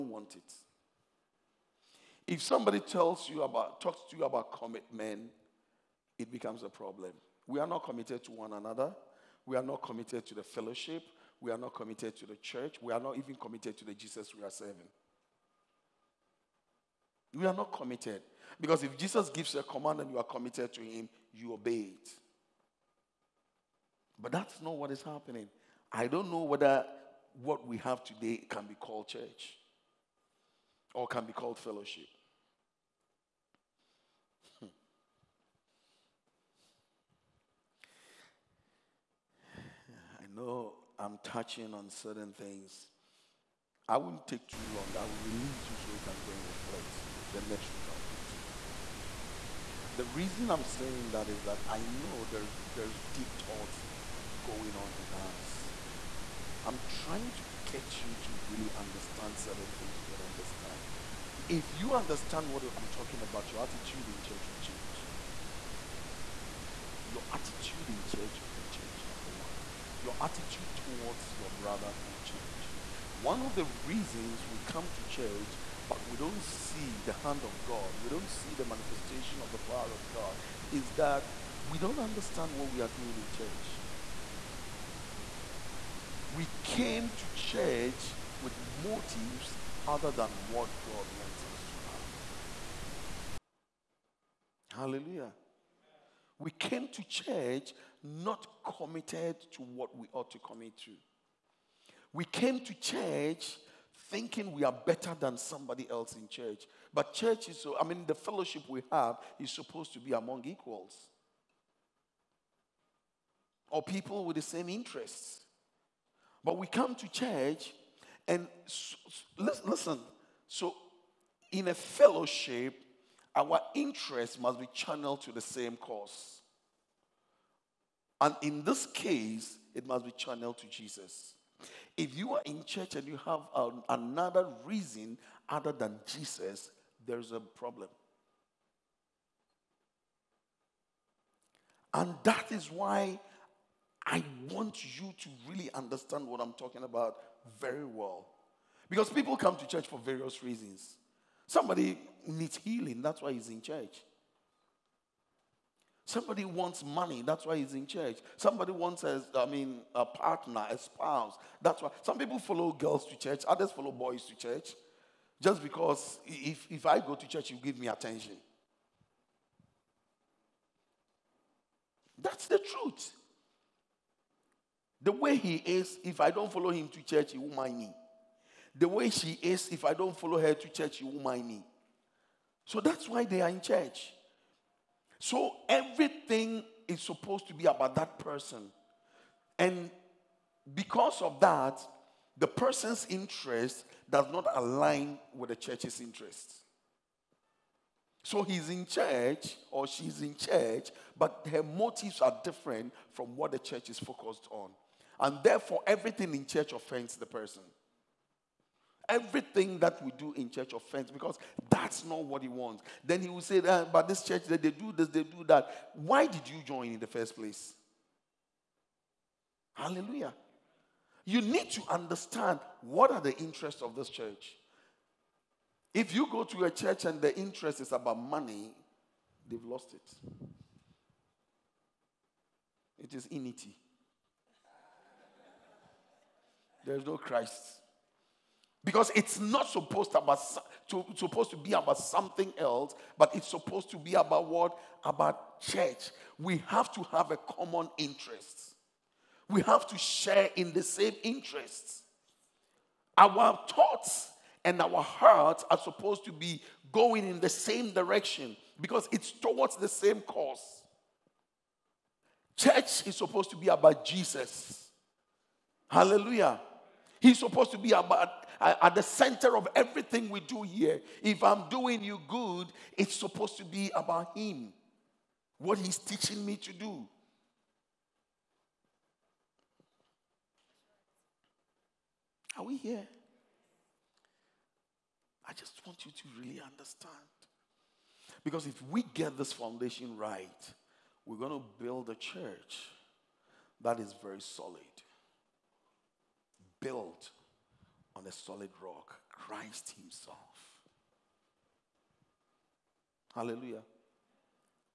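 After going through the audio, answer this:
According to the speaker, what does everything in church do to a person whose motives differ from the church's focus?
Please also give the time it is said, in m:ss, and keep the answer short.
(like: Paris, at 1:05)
offends the person, at 3:26.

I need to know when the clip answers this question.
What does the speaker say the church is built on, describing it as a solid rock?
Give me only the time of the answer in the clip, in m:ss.
4:59.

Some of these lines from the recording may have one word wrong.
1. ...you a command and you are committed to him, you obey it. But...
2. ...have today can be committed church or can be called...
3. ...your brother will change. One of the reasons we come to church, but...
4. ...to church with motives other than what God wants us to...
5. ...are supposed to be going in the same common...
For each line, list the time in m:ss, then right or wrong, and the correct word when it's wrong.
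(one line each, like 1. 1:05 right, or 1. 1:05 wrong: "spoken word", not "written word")
1. 0:19 right
2. 0:27 wrong: "called", not "committed"
3. 1:11 right
4. 1:27 right
5. 4:15 wrong: "direction", not "common".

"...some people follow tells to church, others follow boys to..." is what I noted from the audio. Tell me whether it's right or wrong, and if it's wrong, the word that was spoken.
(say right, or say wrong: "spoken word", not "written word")
wrong: "girls", not "tells".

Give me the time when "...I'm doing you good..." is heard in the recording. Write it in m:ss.
4:31.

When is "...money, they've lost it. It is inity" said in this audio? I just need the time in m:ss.
3:48.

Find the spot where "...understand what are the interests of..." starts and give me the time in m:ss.
3:41.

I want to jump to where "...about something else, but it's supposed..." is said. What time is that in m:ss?
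4:01.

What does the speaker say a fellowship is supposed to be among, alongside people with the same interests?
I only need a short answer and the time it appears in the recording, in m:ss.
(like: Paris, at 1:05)
equals, at 1:50.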